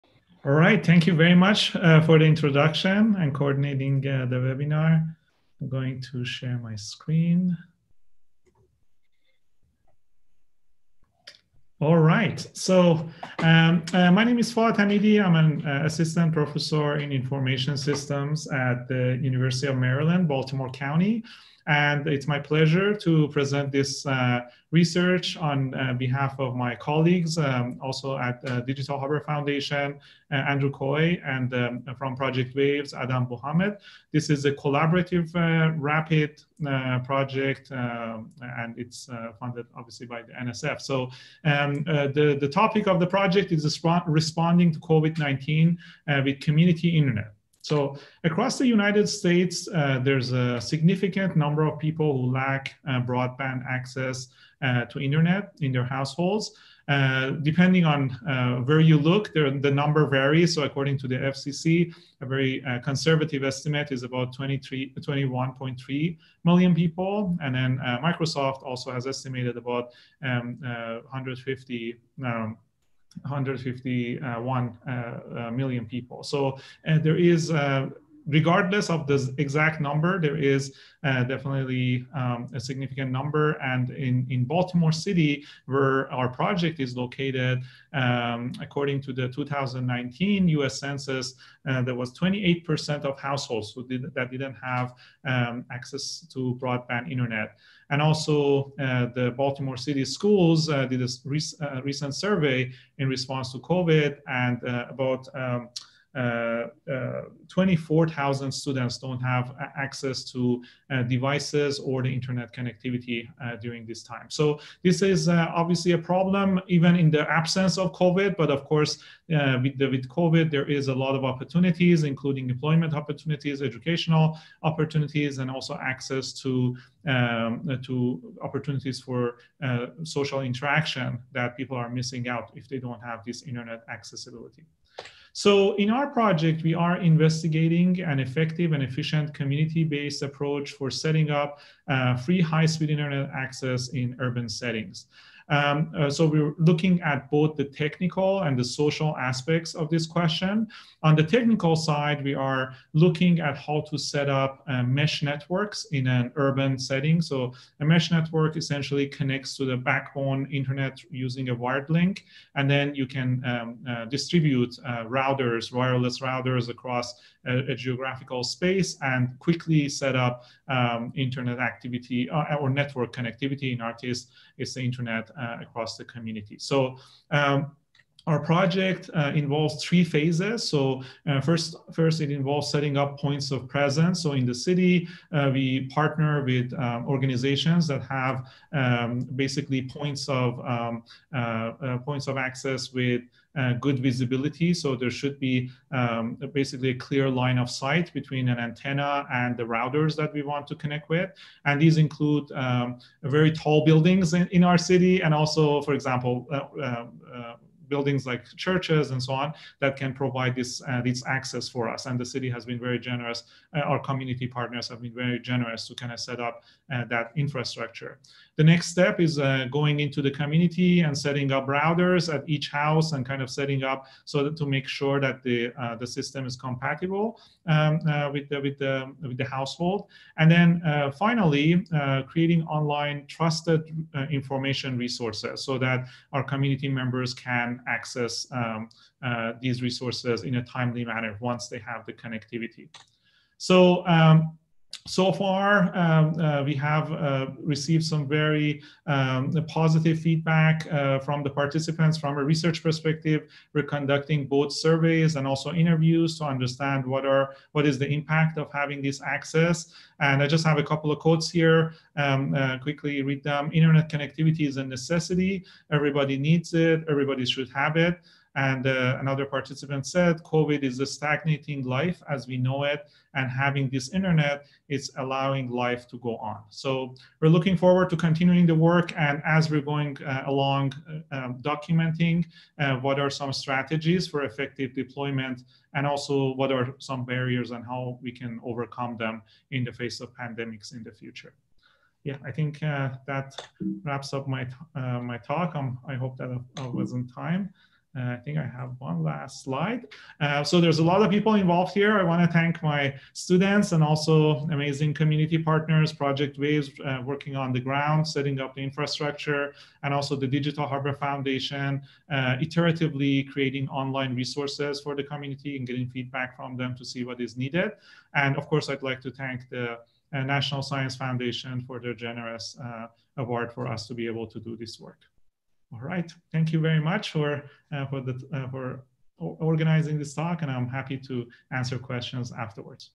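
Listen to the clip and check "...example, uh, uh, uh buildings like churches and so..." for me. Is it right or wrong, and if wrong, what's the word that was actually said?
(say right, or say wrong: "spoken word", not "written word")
right.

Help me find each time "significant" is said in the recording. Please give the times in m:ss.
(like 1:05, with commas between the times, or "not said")
0:50, 1:22.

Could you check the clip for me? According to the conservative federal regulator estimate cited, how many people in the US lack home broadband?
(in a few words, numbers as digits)
21.3 million.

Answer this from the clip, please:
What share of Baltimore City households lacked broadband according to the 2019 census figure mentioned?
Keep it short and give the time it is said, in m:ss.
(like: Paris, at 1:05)
28%, at 1:32.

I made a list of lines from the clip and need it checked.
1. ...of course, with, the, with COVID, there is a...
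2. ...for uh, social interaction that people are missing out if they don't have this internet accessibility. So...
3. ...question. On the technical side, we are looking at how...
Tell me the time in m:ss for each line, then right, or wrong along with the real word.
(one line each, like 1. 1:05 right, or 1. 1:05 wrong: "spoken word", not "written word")
1. 1:58 right
2. 2:09 right
3. 2:30 right.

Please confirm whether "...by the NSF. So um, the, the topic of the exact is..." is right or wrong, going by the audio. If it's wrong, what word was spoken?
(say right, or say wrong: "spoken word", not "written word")
wrong: "project", not "exact".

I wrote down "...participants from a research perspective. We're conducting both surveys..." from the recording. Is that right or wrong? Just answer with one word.
right.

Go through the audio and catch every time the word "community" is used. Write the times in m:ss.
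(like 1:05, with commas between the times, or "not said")
0:46, 2:19, 2:56, 3:34, 3:40, 3:56, 5:05, 5:15.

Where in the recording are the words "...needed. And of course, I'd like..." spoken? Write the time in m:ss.
5:17.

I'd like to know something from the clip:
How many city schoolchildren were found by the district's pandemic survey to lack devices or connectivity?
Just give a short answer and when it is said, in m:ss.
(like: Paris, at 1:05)
24,000, at 1:47.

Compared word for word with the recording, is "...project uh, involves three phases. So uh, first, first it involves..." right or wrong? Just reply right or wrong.
right.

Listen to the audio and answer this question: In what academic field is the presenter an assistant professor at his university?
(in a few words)
Information systems.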